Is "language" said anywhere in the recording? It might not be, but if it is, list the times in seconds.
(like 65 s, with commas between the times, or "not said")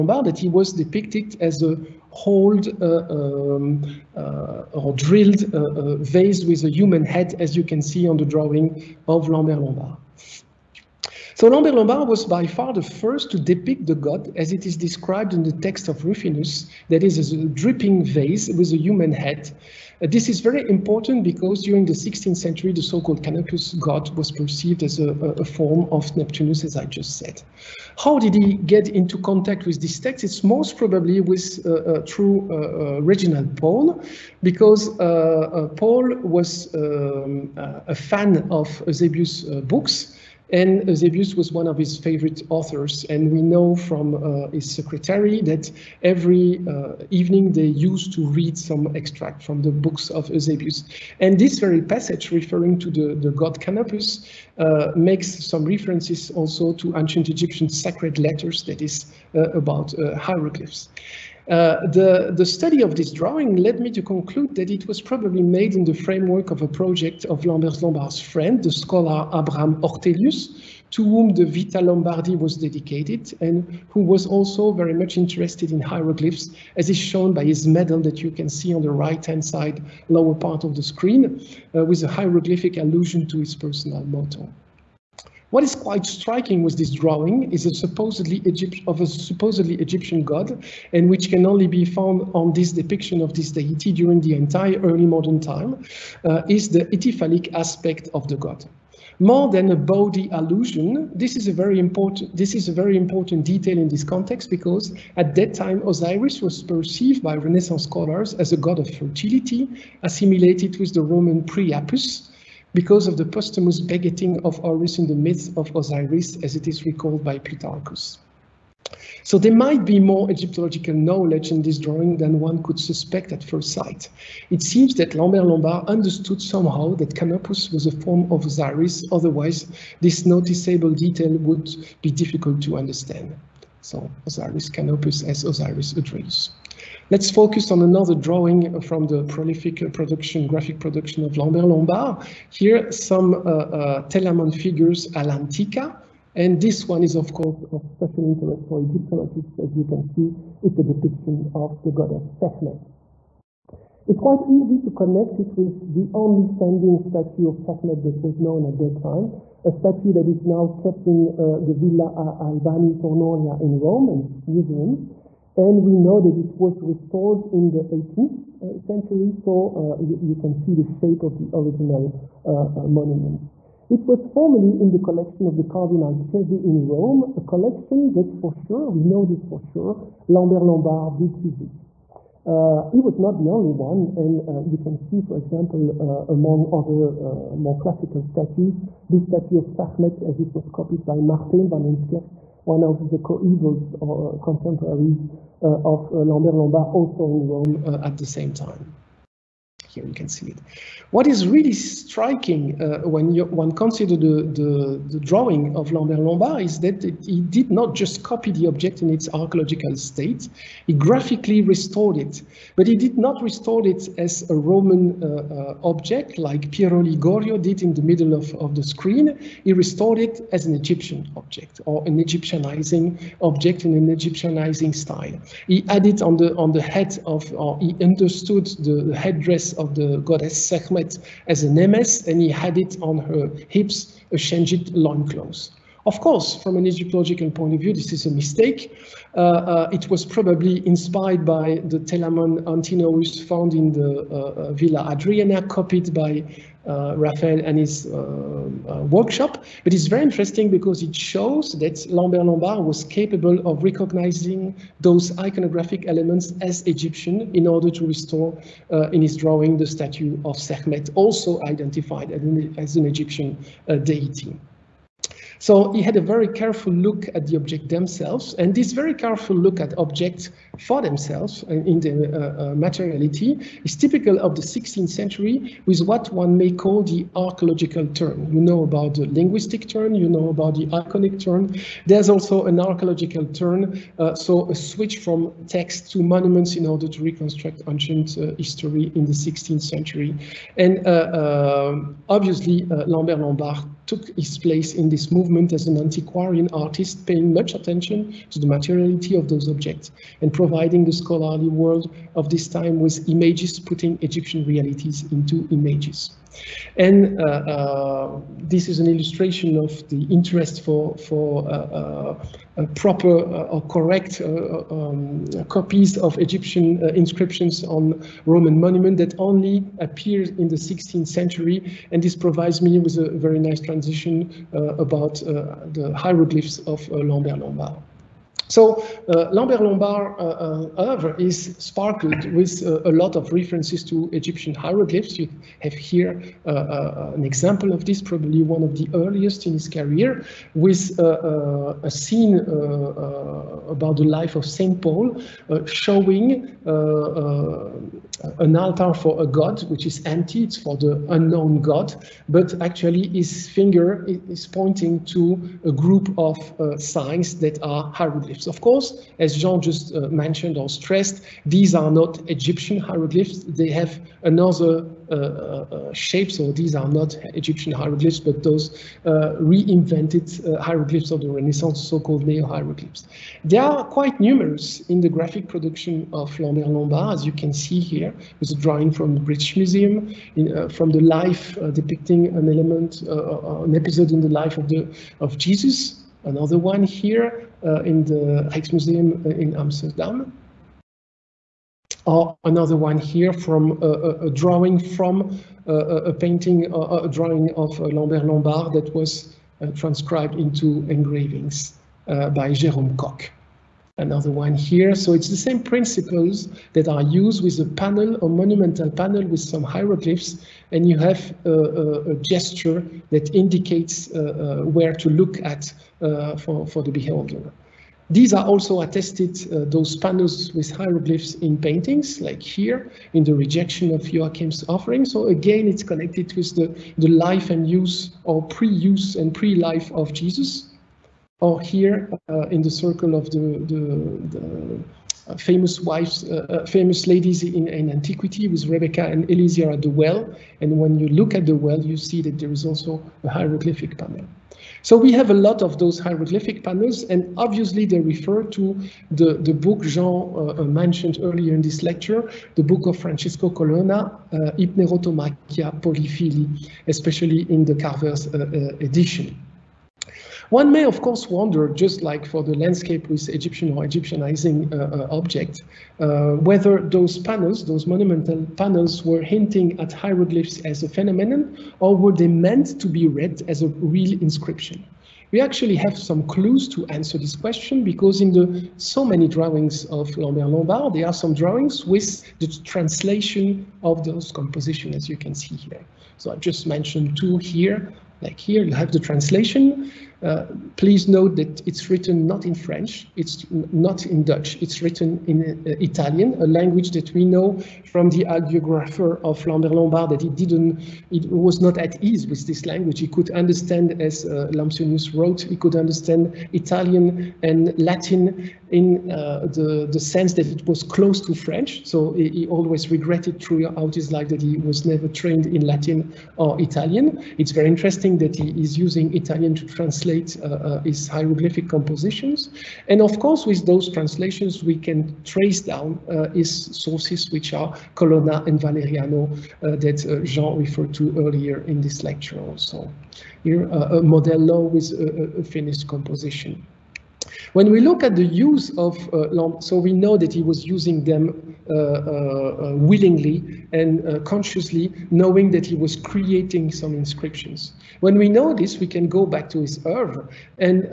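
496 s, 502 s.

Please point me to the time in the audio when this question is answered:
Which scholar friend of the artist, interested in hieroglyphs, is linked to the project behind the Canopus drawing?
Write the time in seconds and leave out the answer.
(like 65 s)
69 s.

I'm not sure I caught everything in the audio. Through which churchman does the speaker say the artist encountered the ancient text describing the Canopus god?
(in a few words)
Reginald Pole.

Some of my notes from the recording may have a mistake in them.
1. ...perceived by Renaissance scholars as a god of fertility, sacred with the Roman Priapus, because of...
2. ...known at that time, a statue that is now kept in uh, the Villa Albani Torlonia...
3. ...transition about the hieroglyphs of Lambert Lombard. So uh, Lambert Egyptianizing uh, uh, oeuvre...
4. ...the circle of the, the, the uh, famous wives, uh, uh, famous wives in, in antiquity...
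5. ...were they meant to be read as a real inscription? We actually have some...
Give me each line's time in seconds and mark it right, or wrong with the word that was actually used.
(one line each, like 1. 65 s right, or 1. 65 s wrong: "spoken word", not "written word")
1. 106 s wrong: "assimilated", not "sacred"
2. 158 s right
3. 323 s wrong: "Lombard", not "Egyptianizing"
4. 432 s wrong: "ladies", not "wives"
5. 472 s right.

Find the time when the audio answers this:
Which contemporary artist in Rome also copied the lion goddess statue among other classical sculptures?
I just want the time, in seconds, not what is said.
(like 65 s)
191 s.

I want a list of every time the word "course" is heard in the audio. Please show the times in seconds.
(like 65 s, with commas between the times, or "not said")
147 s, 236 s, 358 s, 461 s, 523 s.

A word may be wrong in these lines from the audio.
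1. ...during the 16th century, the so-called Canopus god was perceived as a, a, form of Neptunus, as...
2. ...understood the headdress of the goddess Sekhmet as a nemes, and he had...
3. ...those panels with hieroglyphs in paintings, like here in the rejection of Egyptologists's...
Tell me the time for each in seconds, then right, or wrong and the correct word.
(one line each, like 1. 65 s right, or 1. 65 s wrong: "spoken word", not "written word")
1. 21 s right
2. 228 s right
3. 419 s wrong: "Joachim", not "Egyptologists".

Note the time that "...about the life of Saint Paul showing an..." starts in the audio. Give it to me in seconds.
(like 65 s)
343 s.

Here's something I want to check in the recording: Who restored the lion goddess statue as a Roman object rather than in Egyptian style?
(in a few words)
Pirro Ligorio.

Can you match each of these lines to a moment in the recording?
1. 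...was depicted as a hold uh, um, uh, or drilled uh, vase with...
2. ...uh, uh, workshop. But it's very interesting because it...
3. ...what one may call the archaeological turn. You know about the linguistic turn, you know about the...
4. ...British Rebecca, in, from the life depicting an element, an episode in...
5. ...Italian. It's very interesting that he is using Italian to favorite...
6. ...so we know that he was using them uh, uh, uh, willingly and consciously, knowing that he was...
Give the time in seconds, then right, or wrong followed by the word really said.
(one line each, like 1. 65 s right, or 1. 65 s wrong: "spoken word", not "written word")
1. 0 s right
2. 248 s right
3. 276 s right
4. 379 s wrong: "Museum", not "Rebecca"
5. 516 s wrong: "translate", not "favorite"
6. 539 s right.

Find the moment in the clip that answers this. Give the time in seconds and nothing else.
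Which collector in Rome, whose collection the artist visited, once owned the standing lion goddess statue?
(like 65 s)
175 s.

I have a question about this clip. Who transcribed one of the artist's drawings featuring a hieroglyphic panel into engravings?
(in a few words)
Jérôme Cock.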